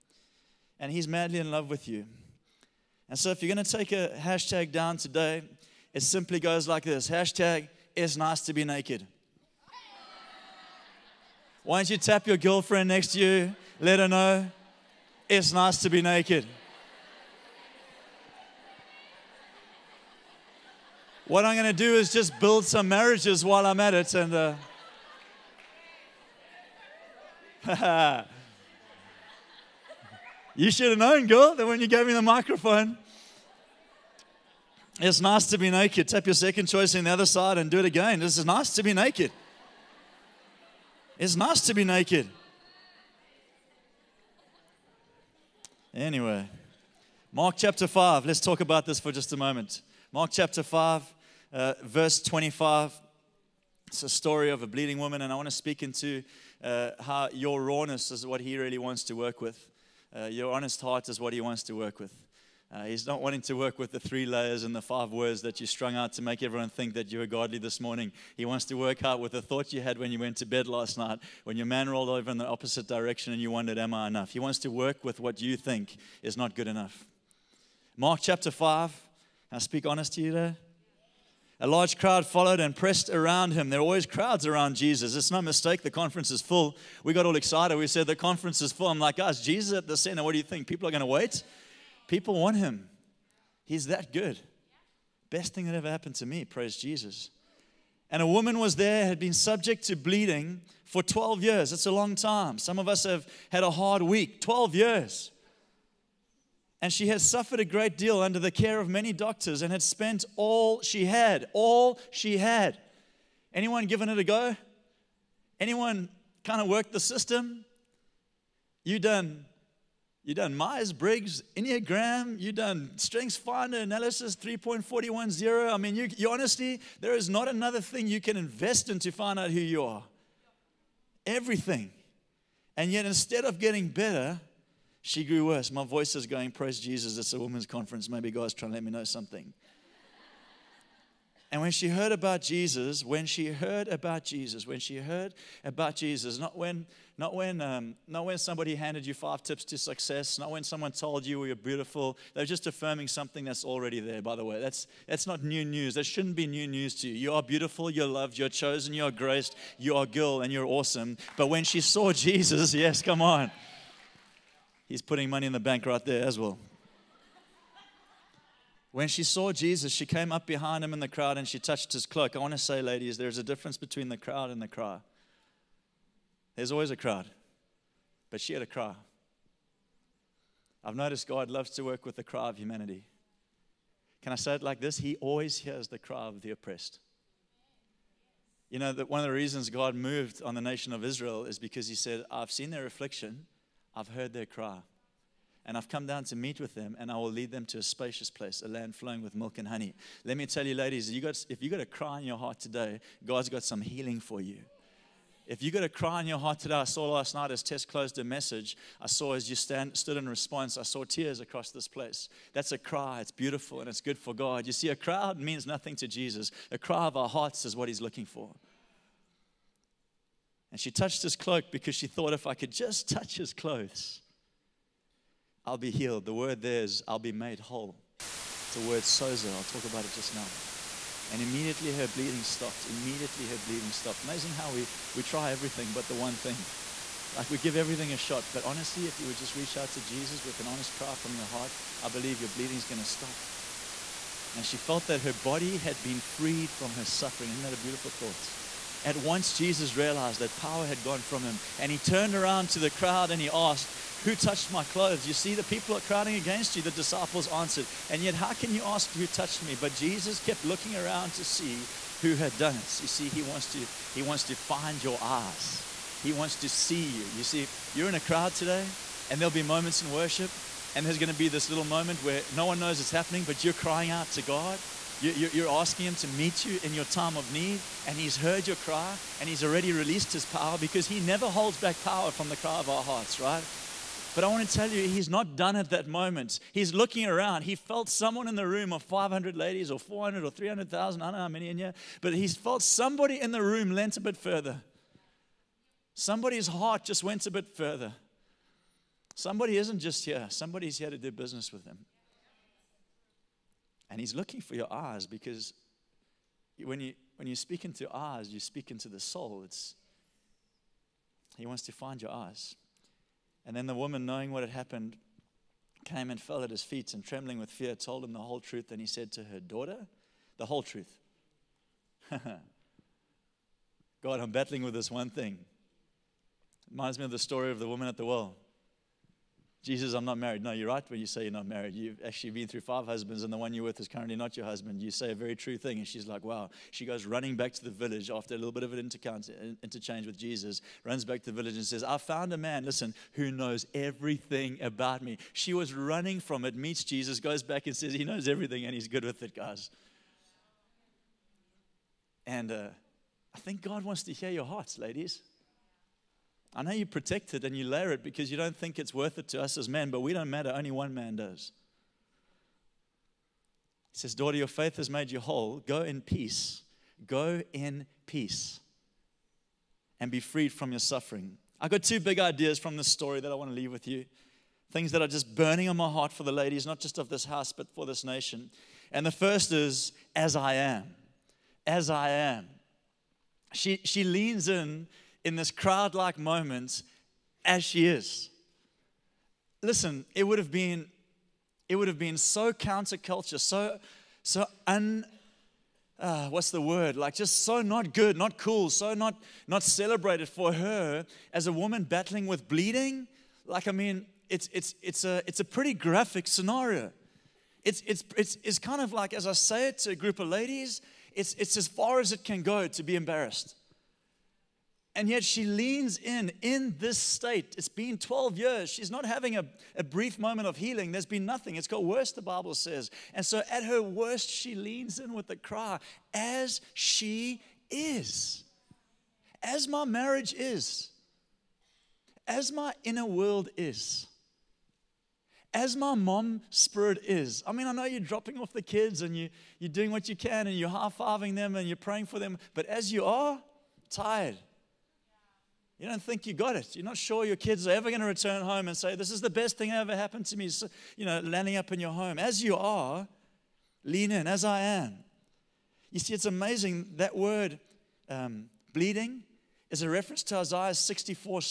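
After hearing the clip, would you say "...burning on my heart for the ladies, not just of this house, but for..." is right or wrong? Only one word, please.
right.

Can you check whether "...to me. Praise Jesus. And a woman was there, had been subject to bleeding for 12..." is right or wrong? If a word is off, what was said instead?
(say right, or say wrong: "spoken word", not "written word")
right.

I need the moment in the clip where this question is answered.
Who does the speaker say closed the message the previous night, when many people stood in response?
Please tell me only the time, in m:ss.
3:27.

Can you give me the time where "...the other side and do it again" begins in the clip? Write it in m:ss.
0:37.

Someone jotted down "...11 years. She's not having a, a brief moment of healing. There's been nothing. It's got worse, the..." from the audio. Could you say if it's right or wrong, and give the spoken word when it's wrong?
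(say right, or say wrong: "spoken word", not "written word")
wrong: "12", not "11".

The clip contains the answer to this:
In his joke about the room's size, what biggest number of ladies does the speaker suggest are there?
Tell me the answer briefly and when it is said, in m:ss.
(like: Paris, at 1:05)
300,000, at 4:50.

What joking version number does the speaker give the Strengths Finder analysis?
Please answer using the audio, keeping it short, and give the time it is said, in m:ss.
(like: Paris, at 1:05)
3.410, at 2:04.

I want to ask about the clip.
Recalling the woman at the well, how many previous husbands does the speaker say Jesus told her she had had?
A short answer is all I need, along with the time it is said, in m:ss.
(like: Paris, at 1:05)
5, at 5:32.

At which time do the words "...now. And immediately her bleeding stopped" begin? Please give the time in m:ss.
3:50.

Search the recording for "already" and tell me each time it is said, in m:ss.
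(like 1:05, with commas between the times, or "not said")
2:33, 4:39.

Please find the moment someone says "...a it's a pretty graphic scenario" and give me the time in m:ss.
6:45.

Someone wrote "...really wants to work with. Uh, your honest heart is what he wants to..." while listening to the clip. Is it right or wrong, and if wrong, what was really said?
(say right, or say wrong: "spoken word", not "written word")
right.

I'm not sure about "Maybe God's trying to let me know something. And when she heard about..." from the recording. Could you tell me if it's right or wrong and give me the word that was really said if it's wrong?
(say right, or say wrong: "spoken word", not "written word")
right.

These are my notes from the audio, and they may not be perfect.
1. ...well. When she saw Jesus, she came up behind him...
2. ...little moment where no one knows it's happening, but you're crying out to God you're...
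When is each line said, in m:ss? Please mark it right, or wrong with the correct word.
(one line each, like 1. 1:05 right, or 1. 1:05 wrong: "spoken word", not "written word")
1. 2:46 right
2. 4:31 right.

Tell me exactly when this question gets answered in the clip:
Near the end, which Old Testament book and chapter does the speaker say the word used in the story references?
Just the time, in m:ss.
7:40.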